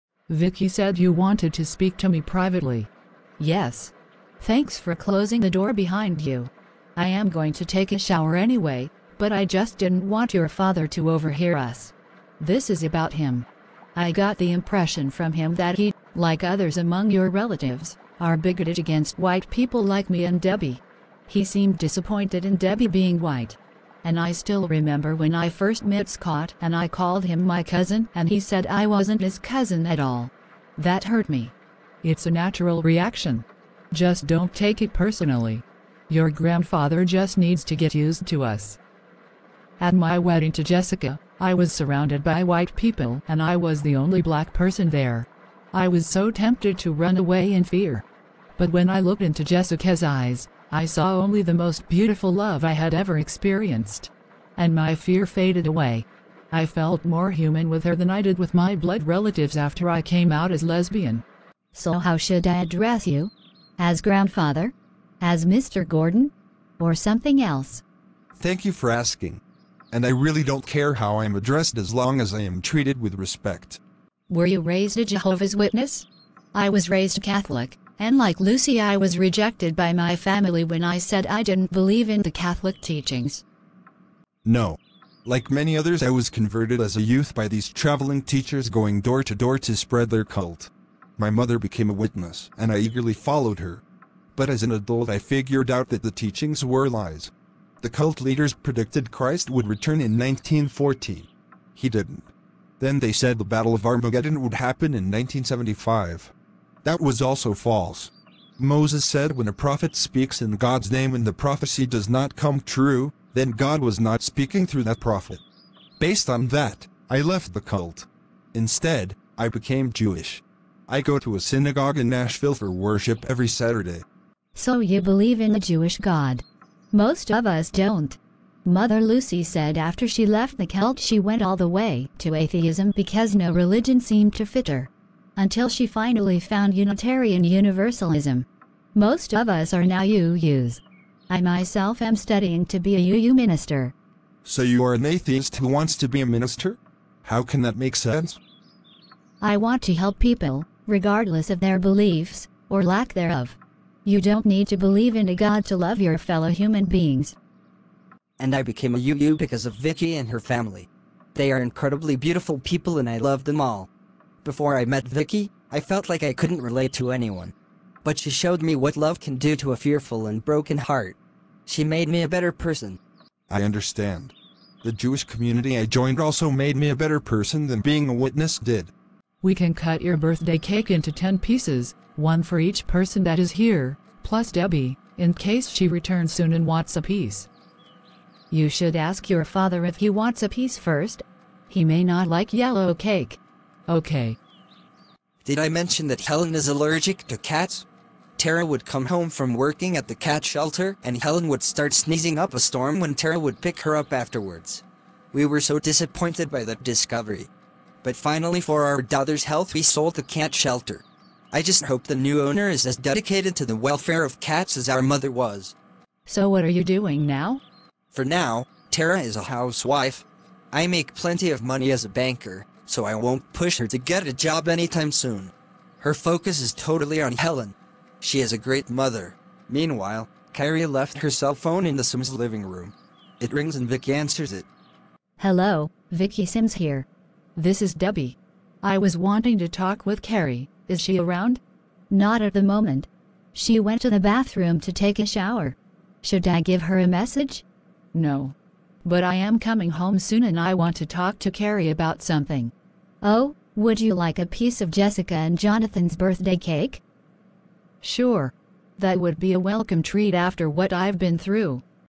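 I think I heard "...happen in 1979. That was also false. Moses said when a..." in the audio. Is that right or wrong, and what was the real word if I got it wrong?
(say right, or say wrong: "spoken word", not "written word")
wrong: "1975", not "1979".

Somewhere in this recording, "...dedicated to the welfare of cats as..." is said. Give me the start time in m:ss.
3:32.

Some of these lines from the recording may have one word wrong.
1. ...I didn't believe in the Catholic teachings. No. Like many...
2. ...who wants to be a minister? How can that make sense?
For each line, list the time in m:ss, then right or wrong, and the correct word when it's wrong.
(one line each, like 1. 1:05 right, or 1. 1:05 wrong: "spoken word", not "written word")
1. 1:21 right
2. 2:25 right.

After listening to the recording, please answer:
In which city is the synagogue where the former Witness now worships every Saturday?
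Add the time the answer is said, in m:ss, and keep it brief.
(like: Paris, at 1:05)
Nashville, at 2:02.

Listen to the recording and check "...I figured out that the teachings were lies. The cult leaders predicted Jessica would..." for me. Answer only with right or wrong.
wrong.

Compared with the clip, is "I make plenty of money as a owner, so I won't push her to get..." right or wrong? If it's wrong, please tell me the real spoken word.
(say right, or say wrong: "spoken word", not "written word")
wrong: "banker", not "owner".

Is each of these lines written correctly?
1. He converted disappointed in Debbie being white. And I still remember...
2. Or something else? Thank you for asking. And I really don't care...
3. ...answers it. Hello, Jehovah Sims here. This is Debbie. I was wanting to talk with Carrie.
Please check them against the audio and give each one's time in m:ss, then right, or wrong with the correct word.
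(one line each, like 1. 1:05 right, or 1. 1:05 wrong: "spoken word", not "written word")
1. 0:21 wrong: "seemed", not "converted"
2. 1:06 right
3. 3:54 wrong: "Vicky", not "Jehovah".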